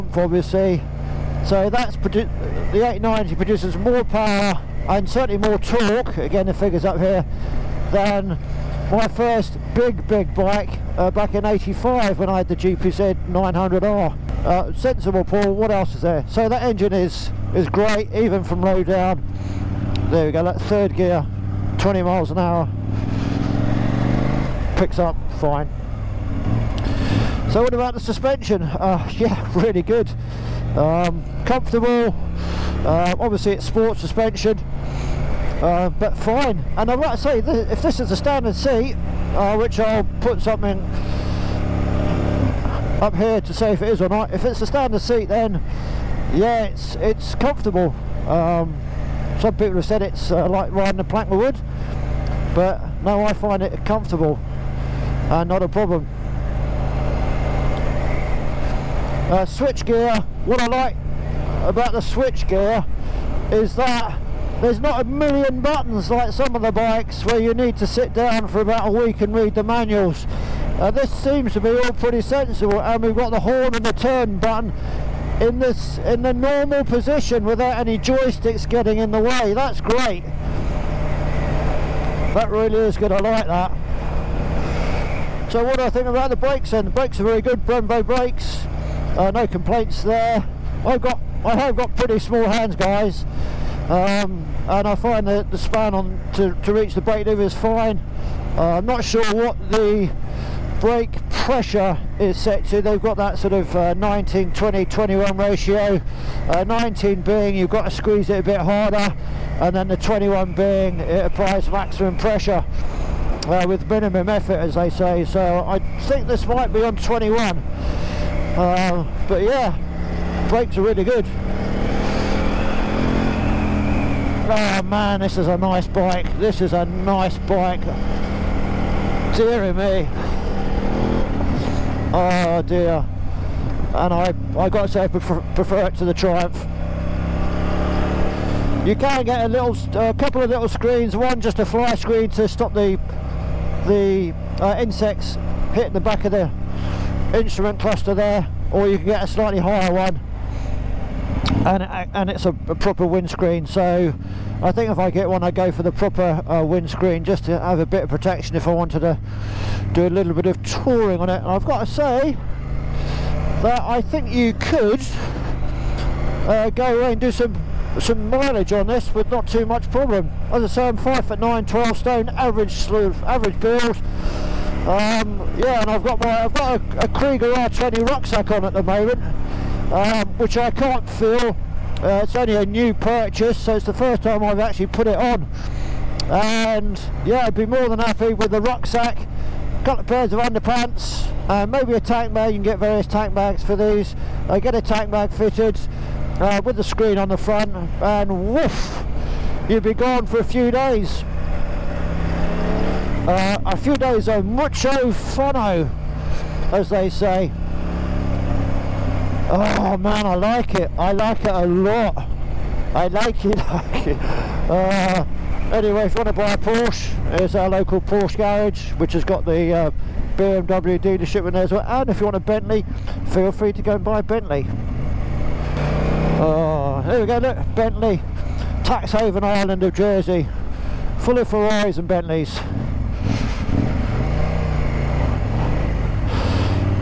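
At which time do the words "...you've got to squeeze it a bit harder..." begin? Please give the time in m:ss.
1:47.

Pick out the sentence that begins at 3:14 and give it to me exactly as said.
I get a tank bag fitted uh, with the screen on the front, and woof, you'd be gone for a few days.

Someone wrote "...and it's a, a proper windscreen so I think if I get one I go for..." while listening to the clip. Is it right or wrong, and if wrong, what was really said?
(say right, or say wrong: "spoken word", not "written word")
right.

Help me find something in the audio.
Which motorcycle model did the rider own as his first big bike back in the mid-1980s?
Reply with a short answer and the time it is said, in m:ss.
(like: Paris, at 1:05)
GPZ 900R, at 0:12.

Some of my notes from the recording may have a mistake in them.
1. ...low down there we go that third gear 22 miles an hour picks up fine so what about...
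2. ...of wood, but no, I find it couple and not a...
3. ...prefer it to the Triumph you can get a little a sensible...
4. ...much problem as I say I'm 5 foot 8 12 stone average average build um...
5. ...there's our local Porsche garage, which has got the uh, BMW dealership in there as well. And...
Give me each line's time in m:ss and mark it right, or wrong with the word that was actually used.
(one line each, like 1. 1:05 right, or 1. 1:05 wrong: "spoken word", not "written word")
1. 0:18 wrong: "20", not "22"
2. 0:51 wrong: "comfortable", not "couple"
3. 2:15 wrong: "couple", not "sensible"
4. 2:49 wrong: "9", not "8"
5. 3:37 right.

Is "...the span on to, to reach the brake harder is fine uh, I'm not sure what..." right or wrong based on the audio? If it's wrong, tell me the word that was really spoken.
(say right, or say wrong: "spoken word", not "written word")
wrong: "lever", not "harder".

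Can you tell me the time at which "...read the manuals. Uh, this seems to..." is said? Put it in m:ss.
1:09.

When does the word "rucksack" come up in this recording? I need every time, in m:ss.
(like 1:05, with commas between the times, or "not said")
2:58, 3:08.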